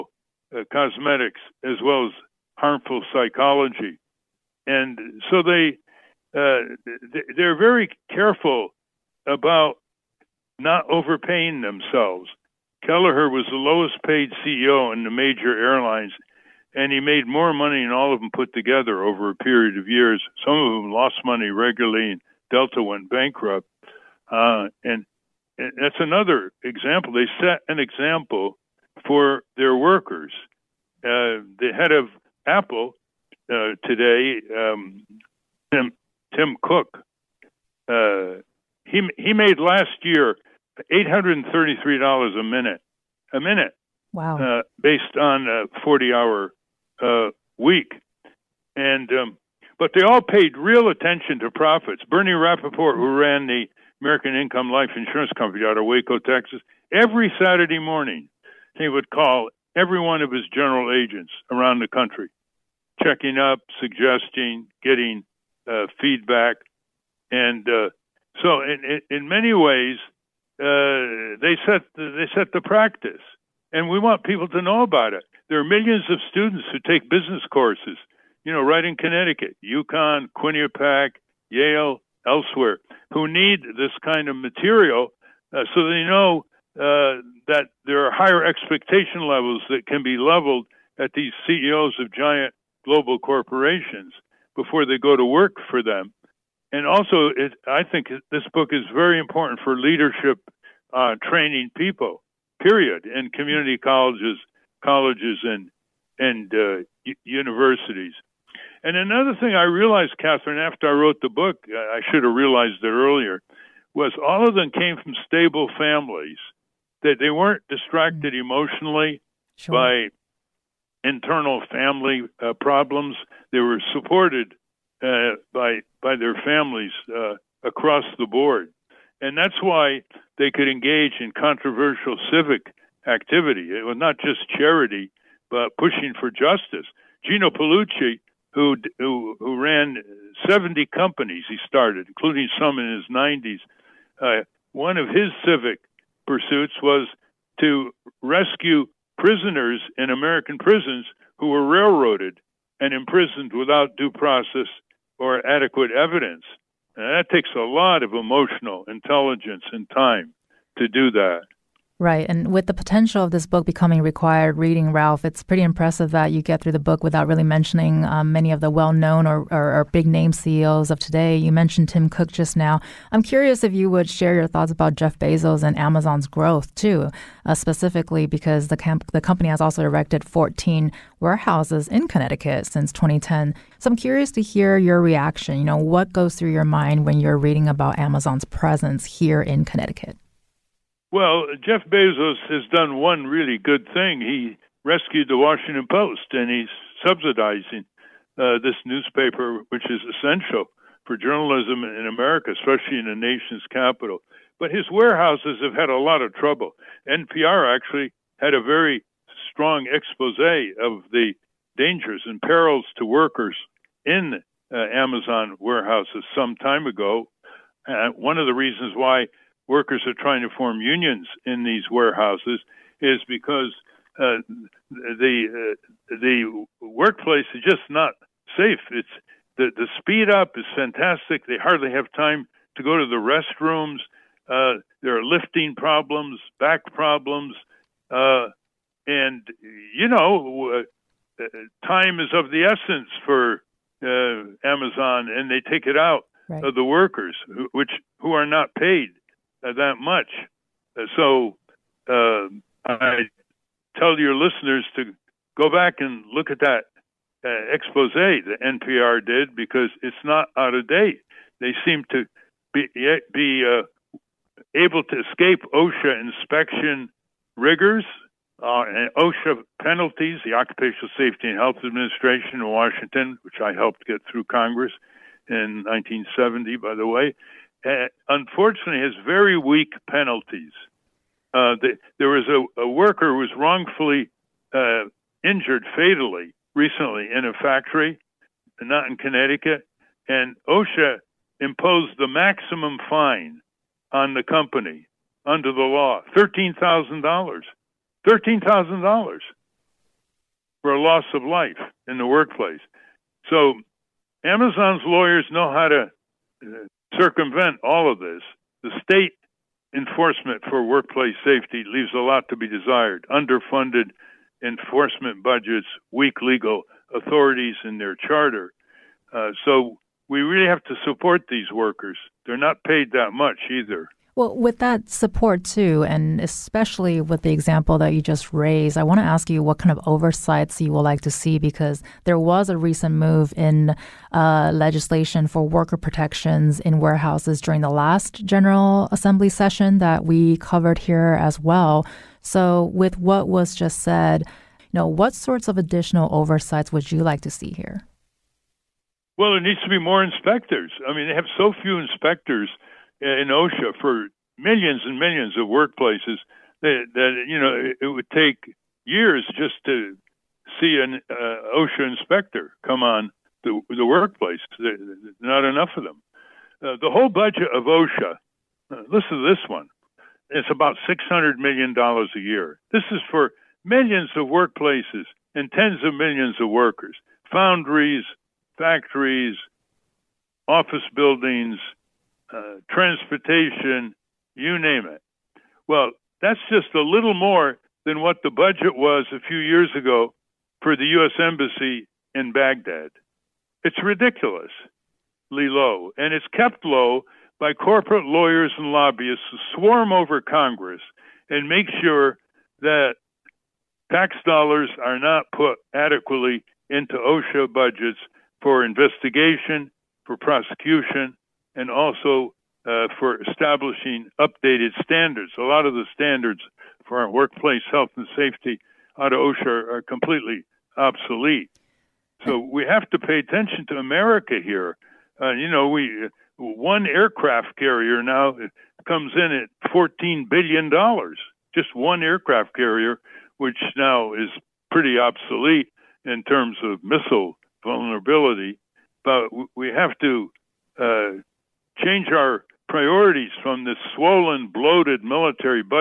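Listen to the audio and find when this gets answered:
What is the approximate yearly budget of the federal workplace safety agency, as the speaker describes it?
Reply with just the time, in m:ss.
6:11.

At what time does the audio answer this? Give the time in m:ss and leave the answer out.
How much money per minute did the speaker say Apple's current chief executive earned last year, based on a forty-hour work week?
0:40.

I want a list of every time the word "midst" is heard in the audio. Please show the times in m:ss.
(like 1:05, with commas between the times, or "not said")
not said.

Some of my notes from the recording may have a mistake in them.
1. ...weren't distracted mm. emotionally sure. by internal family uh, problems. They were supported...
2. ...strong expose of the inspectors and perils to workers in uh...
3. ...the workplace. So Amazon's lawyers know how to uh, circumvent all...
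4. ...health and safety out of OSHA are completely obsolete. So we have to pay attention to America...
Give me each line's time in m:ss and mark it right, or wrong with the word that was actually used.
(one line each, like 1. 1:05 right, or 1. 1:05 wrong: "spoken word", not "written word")
1. 1:57 right
2. 3:29 wrong: "dangers", not "inspectors"
3. 5:02 right
4. 6:57 right.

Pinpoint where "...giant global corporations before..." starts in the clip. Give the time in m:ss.
1:32.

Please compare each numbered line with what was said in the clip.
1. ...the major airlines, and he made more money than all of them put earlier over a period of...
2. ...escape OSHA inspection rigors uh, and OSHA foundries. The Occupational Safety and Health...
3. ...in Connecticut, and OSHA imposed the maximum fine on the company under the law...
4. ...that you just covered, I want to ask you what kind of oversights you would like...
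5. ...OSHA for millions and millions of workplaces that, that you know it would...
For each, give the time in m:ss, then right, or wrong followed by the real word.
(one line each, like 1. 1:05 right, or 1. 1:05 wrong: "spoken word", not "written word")
1. 0:15 wrong: "together", not "earlier"
2. 4:25 wrong: "penalties", not "foundries"
3. 4:49 right
4. 5:27 wrong: "raised", not "covered"
5. 5:53 right.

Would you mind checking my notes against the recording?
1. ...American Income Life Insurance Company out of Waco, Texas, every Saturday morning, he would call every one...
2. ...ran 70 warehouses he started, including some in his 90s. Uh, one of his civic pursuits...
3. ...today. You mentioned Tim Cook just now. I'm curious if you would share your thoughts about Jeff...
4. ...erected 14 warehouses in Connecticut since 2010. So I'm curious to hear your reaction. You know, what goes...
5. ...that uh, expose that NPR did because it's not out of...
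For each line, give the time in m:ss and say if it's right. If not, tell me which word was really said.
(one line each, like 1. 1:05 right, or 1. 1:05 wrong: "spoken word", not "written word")
1. 0:54 right
2. 2:19 wrong: "companies", not "warehouses"
3. 2:50 right
4. 2:59 right
5. 4:16 right.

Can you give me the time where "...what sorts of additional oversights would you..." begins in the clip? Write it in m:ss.
5:45.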